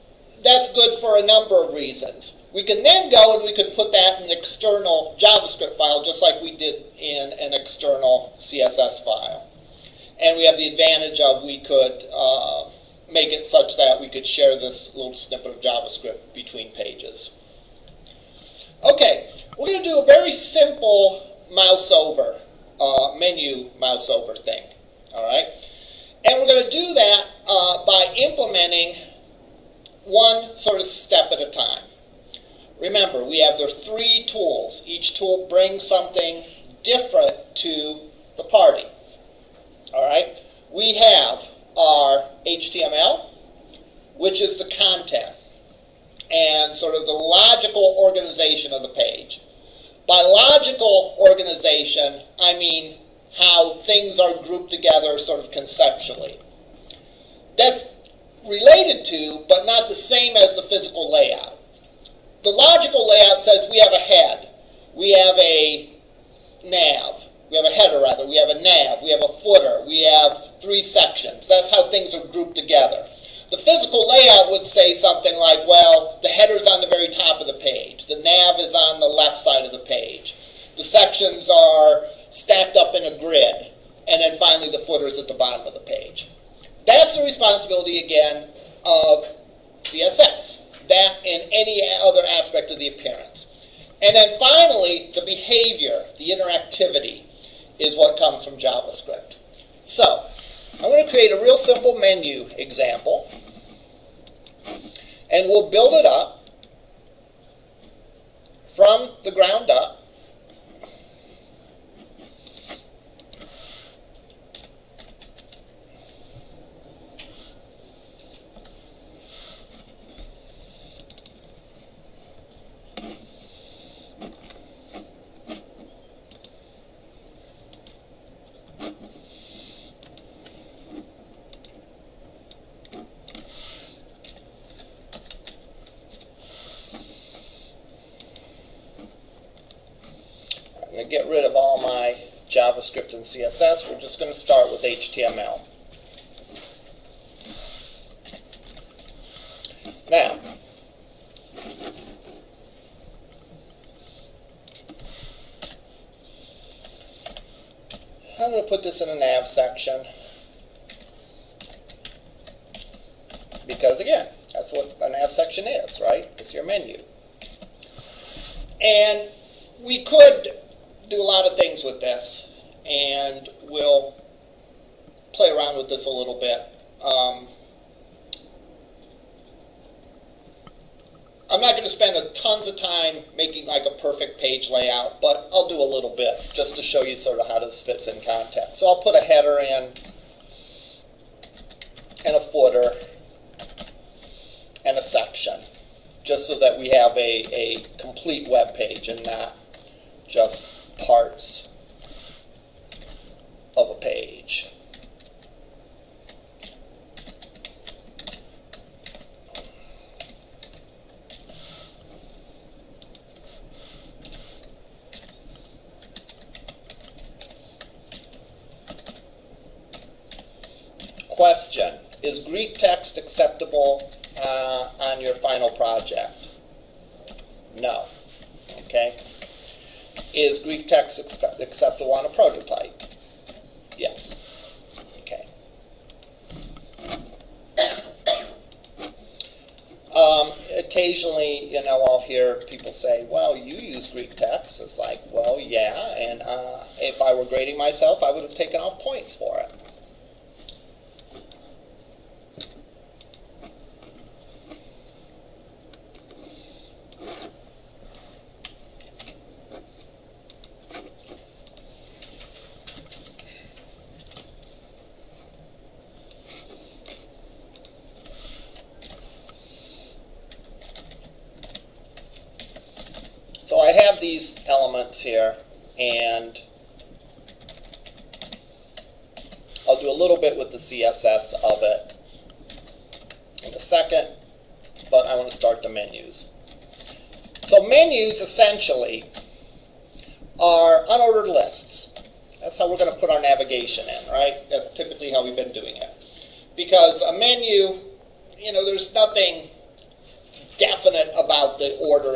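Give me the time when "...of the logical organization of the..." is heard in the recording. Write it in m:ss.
0:46.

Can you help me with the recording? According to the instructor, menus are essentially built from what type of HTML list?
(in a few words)
unordered lists.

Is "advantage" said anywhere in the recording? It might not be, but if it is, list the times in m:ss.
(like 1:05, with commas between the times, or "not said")
0:10.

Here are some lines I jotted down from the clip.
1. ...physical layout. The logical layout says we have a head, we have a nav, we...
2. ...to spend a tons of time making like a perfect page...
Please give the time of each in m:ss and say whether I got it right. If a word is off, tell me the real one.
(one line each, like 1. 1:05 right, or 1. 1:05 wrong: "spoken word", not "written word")
1. 1:00 right
2. 3:01 right.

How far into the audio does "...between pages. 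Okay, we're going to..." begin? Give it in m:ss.
0:16.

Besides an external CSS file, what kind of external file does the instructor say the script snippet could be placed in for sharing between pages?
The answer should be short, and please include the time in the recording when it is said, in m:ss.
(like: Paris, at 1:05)
JavaScript file, at 0:04.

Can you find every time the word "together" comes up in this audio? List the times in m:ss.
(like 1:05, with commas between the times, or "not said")
0:54, 1:12.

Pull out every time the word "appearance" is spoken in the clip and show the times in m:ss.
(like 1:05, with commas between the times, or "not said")
1:32.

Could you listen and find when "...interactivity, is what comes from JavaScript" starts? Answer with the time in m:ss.
1:36.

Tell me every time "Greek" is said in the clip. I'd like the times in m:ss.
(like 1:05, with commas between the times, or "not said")
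3:42, 3:50, 4:04.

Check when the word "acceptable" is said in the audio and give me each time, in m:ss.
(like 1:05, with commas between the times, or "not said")
3:43, 3:51.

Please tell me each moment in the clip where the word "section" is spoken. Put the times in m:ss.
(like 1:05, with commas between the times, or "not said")
1:10, 1:20, 2:39, 2:45, 3:15.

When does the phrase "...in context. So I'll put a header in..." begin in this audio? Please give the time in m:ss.
3:08.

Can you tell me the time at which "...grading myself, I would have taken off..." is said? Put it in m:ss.
4:07.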